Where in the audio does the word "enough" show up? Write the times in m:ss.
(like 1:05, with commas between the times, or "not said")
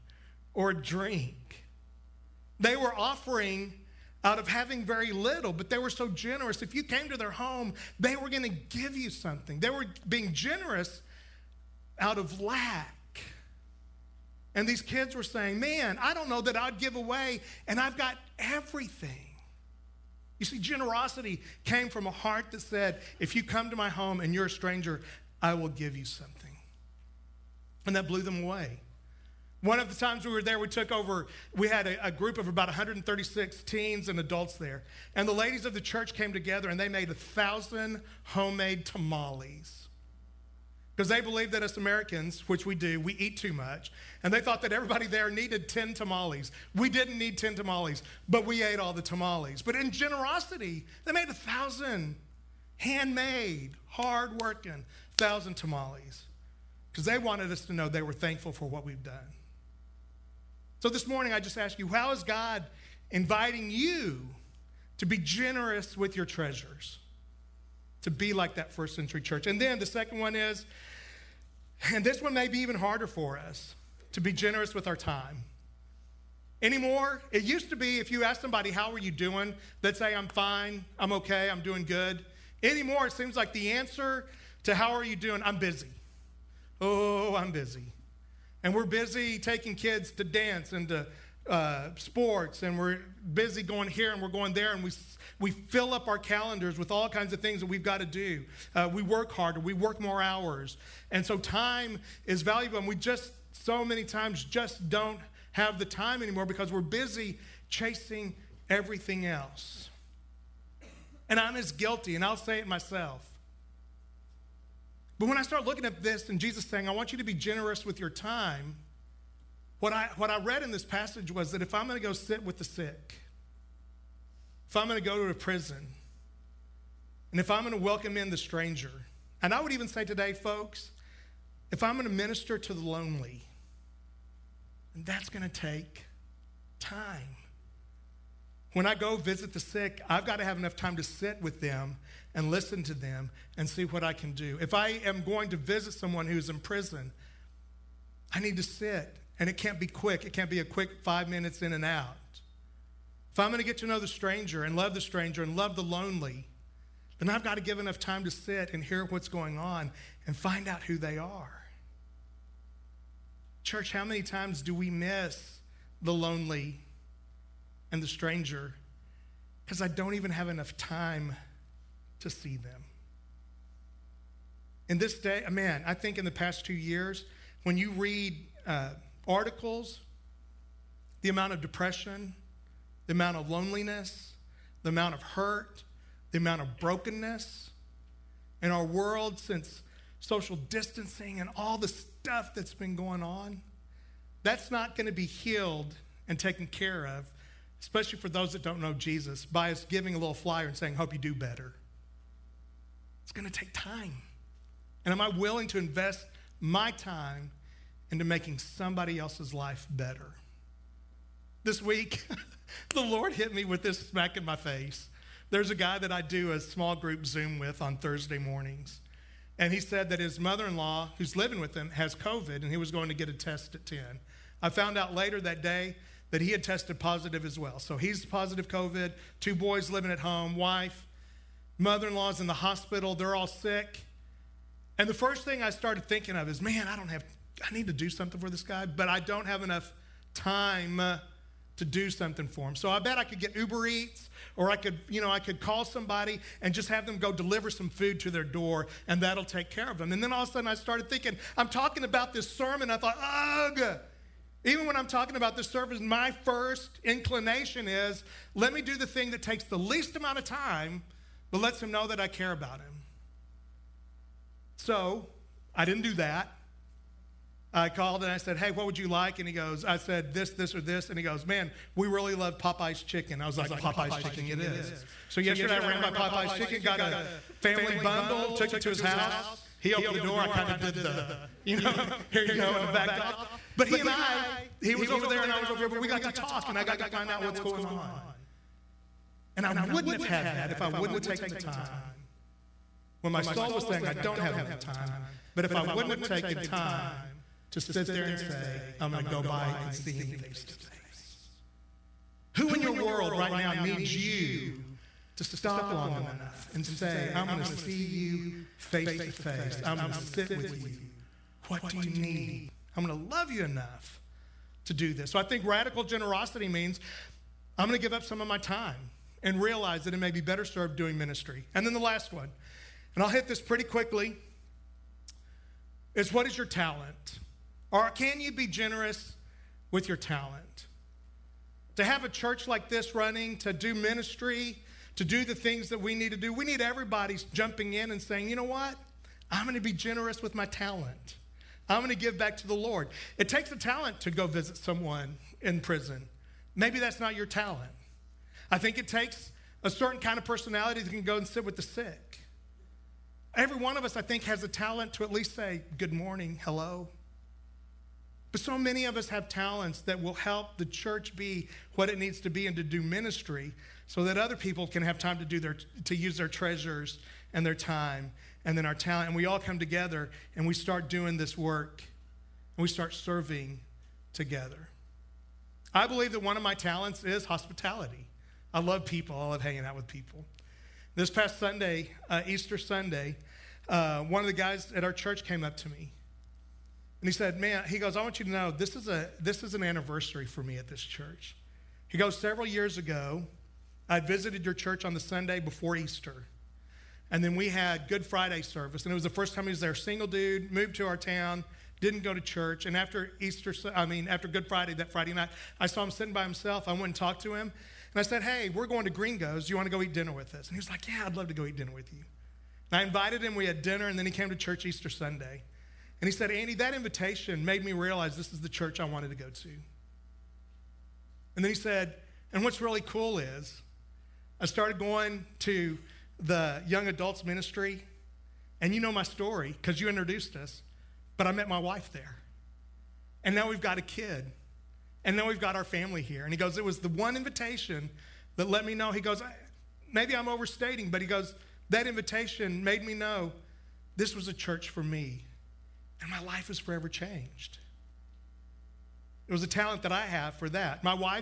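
2:20, 2:37, 2:50, 3:59, 4:54, 5:06, 5:13.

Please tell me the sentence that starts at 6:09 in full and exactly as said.
And we all come together and we start doing this work and we start serving together.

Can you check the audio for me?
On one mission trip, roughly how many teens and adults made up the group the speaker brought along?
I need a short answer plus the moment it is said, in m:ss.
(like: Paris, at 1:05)
136, at 0:32.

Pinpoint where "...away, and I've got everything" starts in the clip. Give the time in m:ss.
0:16.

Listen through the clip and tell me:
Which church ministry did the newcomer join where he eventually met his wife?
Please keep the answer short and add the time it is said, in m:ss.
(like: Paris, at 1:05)
young adults ministry, at 7:06.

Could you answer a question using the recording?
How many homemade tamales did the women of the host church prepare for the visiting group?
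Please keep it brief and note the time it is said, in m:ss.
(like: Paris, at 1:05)
1,000, at 0:37.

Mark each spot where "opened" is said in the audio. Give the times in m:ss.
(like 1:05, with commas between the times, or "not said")
4:39.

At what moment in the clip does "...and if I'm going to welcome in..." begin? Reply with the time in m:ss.
2:07.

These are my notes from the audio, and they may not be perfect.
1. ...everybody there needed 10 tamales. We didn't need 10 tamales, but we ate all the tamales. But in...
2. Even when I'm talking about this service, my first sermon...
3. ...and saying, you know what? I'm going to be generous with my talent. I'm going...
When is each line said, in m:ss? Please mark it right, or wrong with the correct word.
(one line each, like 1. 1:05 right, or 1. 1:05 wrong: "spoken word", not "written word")
1. 0:44 right
2. 4:14 wrong: "inclination", not "sermon"
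3. 5:38 right.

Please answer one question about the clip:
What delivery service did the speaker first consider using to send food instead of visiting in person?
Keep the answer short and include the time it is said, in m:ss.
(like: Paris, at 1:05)
Uber Eats, at 4:03.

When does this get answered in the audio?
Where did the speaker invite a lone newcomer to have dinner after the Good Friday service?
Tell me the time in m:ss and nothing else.
6:49.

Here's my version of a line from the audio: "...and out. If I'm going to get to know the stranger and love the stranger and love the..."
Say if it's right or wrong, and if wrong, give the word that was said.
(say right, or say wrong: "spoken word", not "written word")
right.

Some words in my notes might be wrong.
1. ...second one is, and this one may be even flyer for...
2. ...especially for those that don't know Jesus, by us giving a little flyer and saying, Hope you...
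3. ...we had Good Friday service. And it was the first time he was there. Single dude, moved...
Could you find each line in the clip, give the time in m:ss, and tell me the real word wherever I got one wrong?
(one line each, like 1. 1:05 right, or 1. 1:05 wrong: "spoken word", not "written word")
1. 1:09 wrong: "harder", not "flyer"
2. 3:17 right
3. 6:37 right.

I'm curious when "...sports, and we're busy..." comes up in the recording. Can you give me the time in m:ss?
1:31.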